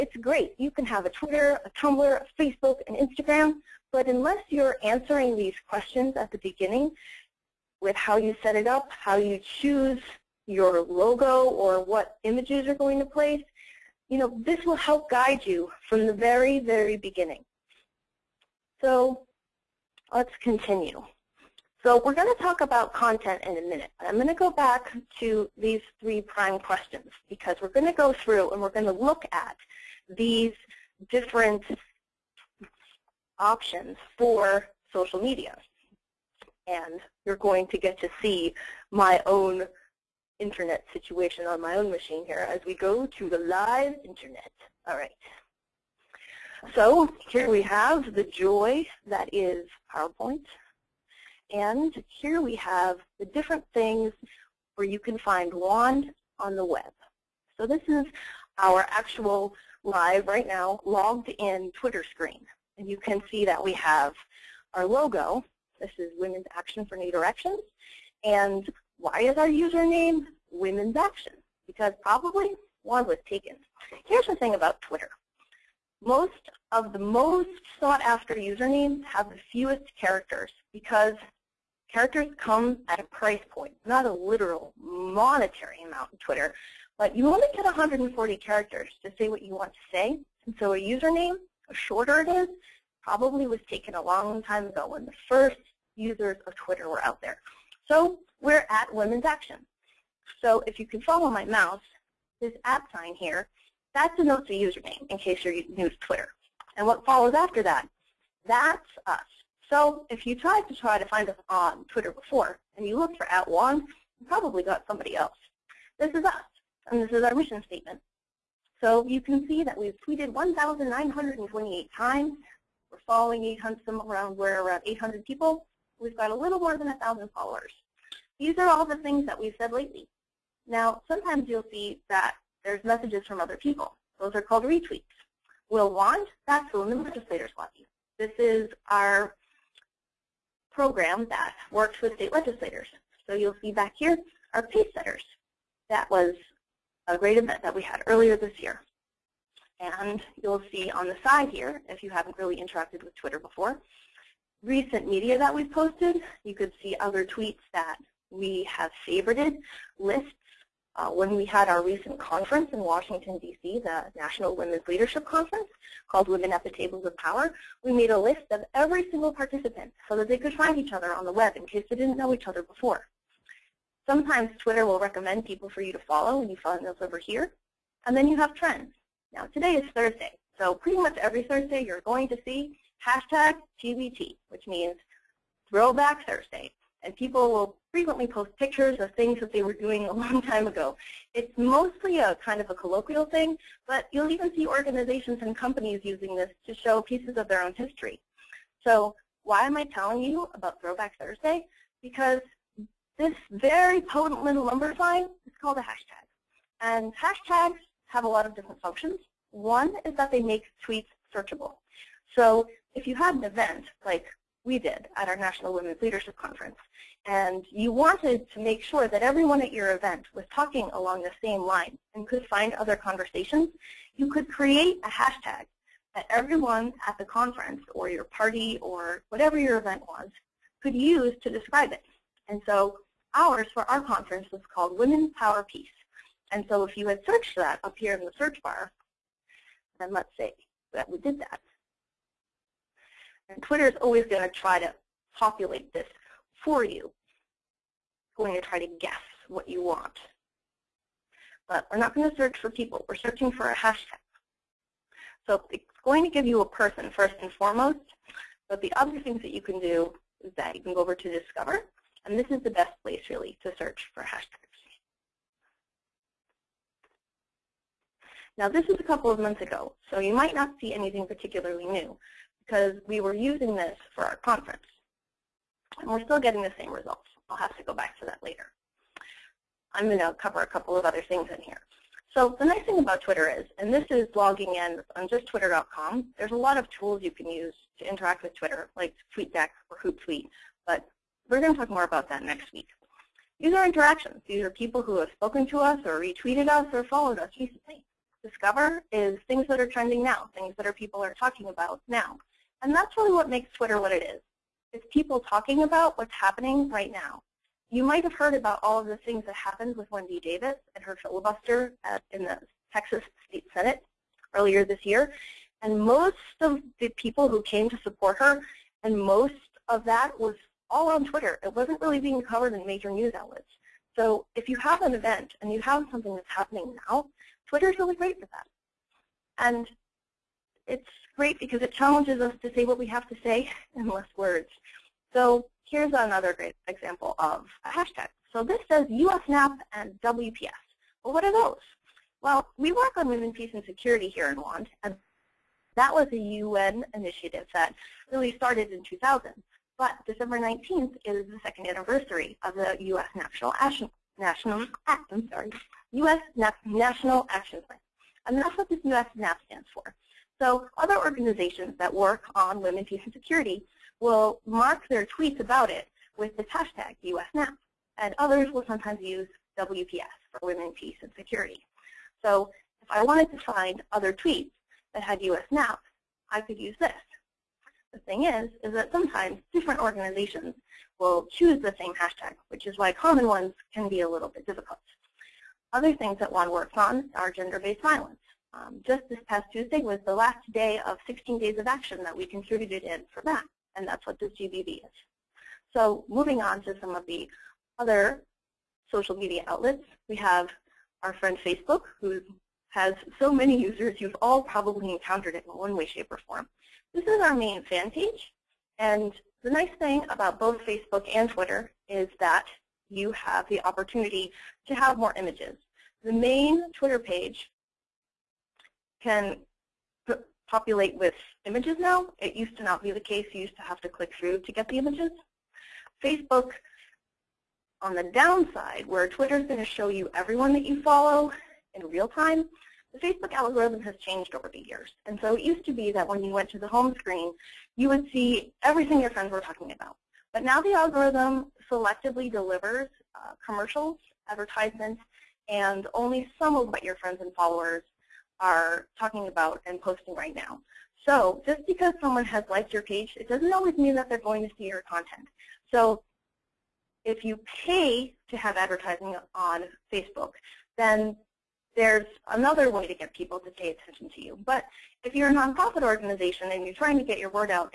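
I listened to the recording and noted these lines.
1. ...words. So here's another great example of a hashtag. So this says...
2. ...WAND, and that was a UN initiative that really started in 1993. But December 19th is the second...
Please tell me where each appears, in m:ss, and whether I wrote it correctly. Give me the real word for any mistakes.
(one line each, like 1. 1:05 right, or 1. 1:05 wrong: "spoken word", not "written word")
1. 5:34 right
2. 5:44 wrong: "2000", not "1993".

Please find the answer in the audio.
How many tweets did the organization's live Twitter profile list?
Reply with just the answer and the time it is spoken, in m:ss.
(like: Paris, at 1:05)
1,928, at 2:00.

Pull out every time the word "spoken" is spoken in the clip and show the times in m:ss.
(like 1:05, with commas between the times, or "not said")
4:55.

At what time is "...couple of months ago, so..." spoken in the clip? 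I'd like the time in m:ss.
4:29.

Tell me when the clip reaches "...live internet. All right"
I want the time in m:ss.
0:43.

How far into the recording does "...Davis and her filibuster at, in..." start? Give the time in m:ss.
5:10.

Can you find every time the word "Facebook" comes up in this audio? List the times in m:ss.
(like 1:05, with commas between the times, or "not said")
0:02, 6:41, 6:50, 7:06, 7:13, 7:40.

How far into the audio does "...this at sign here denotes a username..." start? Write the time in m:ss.
1:42.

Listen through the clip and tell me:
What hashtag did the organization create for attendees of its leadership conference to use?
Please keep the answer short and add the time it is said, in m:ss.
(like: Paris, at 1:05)
Women's Power Peace, at 3:54.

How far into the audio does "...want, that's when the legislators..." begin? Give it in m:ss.
2:15.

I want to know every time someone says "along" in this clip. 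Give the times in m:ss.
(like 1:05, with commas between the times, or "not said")
3:40.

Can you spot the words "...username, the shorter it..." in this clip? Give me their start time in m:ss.
1:30.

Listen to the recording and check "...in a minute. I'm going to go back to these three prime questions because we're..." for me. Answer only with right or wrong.
right.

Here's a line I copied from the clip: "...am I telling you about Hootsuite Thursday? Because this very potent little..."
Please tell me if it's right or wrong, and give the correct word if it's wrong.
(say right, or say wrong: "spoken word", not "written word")
wrong: "Throwback", not "Hootsuite".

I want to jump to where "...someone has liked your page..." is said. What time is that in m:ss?
7:32.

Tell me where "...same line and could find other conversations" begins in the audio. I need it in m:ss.
3:41.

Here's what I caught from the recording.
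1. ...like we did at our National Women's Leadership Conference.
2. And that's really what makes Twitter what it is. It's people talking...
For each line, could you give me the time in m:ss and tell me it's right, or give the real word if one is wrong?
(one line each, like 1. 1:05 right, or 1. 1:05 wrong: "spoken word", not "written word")
1. 3:34 right
2. 5:02 right.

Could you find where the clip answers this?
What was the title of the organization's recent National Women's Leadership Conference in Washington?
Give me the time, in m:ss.
2:46.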